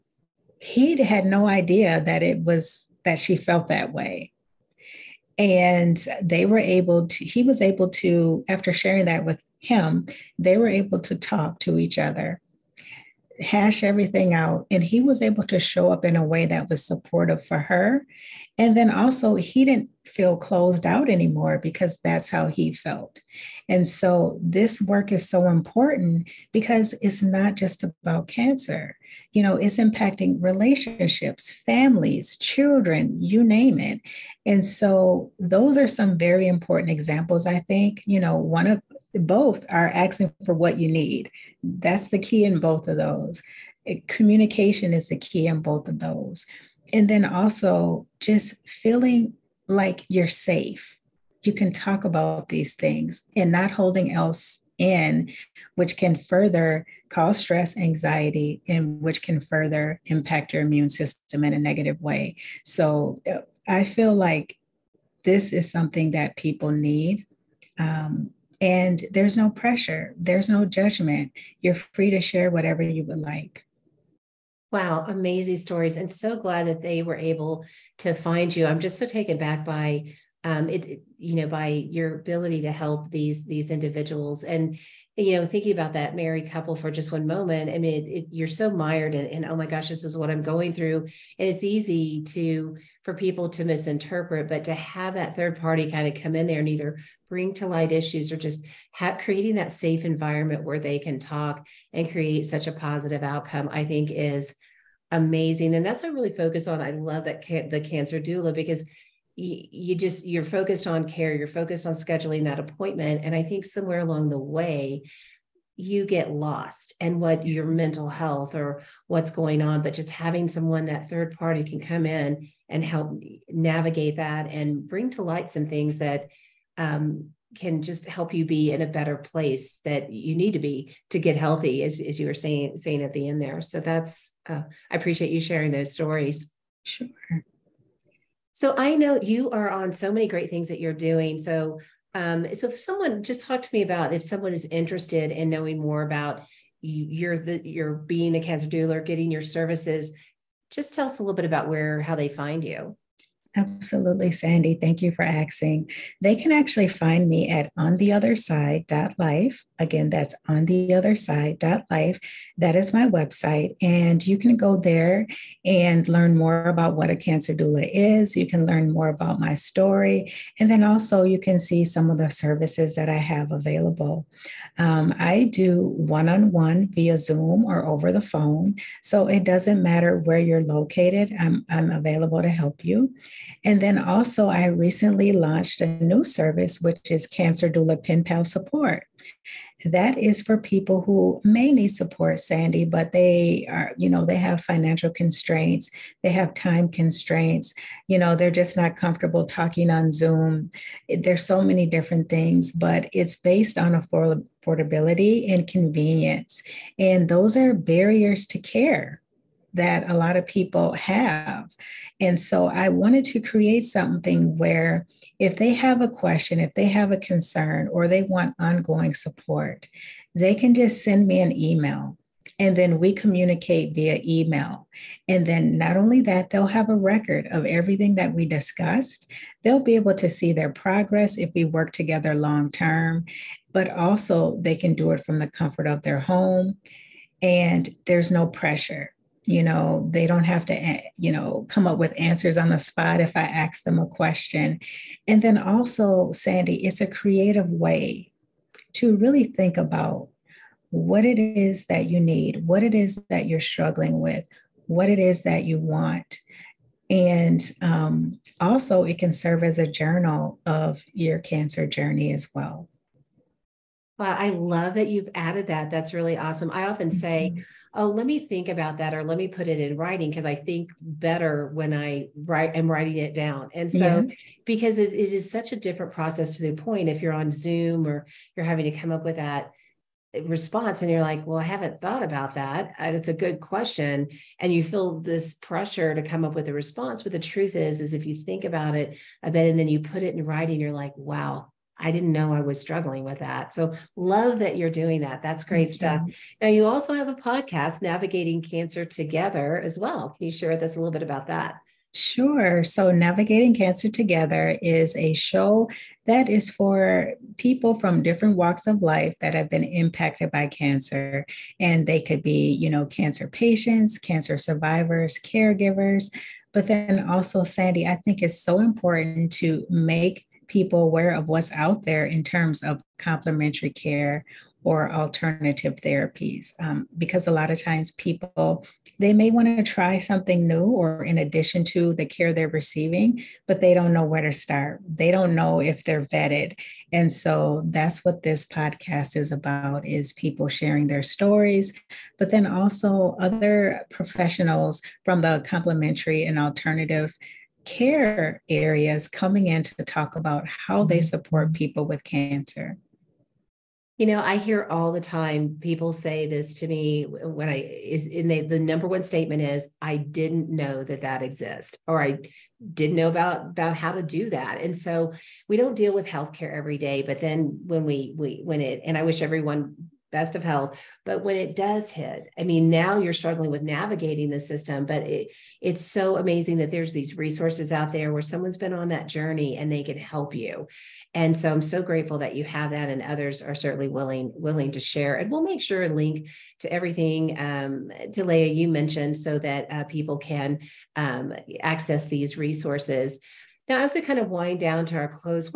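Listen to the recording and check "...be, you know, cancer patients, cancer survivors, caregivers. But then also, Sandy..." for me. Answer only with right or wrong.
right.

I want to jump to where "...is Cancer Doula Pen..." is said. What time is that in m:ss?
3:07.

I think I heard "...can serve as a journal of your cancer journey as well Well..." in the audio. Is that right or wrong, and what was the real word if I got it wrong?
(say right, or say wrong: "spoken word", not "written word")
right.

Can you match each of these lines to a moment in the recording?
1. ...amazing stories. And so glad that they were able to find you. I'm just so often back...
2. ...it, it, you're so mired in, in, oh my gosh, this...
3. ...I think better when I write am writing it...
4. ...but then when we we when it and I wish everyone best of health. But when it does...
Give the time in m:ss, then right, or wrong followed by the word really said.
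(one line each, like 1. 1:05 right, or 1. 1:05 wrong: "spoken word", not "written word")
1. 1:15 wrong: "taken", not "often"
2. 1:28 right
3. 4:30 right
4. 6:07 right.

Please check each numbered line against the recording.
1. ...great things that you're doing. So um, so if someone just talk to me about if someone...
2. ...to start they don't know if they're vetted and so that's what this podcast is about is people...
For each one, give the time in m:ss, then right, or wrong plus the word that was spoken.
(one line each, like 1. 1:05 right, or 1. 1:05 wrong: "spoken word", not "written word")
1. 2:20 right
2. 5:34 right.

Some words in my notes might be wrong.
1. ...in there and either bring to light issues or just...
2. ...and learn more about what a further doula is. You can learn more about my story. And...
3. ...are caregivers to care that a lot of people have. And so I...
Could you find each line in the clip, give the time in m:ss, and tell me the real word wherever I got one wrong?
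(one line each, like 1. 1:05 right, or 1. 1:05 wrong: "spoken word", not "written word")
1. 1:36 right
2. 2:45 wrong: "cancer", not "further"
3. 3:27 wrong: "barriers", not "caregivers".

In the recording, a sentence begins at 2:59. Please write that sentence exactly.
So it doesn't matter where you're located, I'm, I'm available to help you.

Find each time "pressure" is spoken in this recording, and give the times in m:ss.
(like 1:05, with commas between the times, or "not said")
1:09, 3:58, 4:45.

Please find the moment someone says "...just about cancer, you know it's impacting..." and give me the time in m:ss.
0:27.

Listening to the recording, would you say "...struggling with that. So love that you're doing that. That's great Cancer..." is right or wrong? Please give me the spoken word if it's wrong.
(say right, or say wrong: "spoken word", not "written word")
wrong: "Thank", not "Cancer".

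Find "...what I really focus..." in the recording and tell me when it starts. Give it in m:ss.
1:46.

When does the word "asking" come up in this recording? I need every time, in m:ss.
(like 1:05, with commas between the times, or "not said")
0:39, 2:35.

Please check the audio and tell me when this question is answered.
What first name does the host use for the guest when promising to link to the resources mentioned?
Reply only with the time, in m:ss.
6:28.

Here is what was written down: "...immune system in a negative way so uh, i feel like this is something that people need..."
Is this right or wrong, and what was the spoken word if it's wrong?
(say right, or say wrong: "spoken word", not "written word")
right.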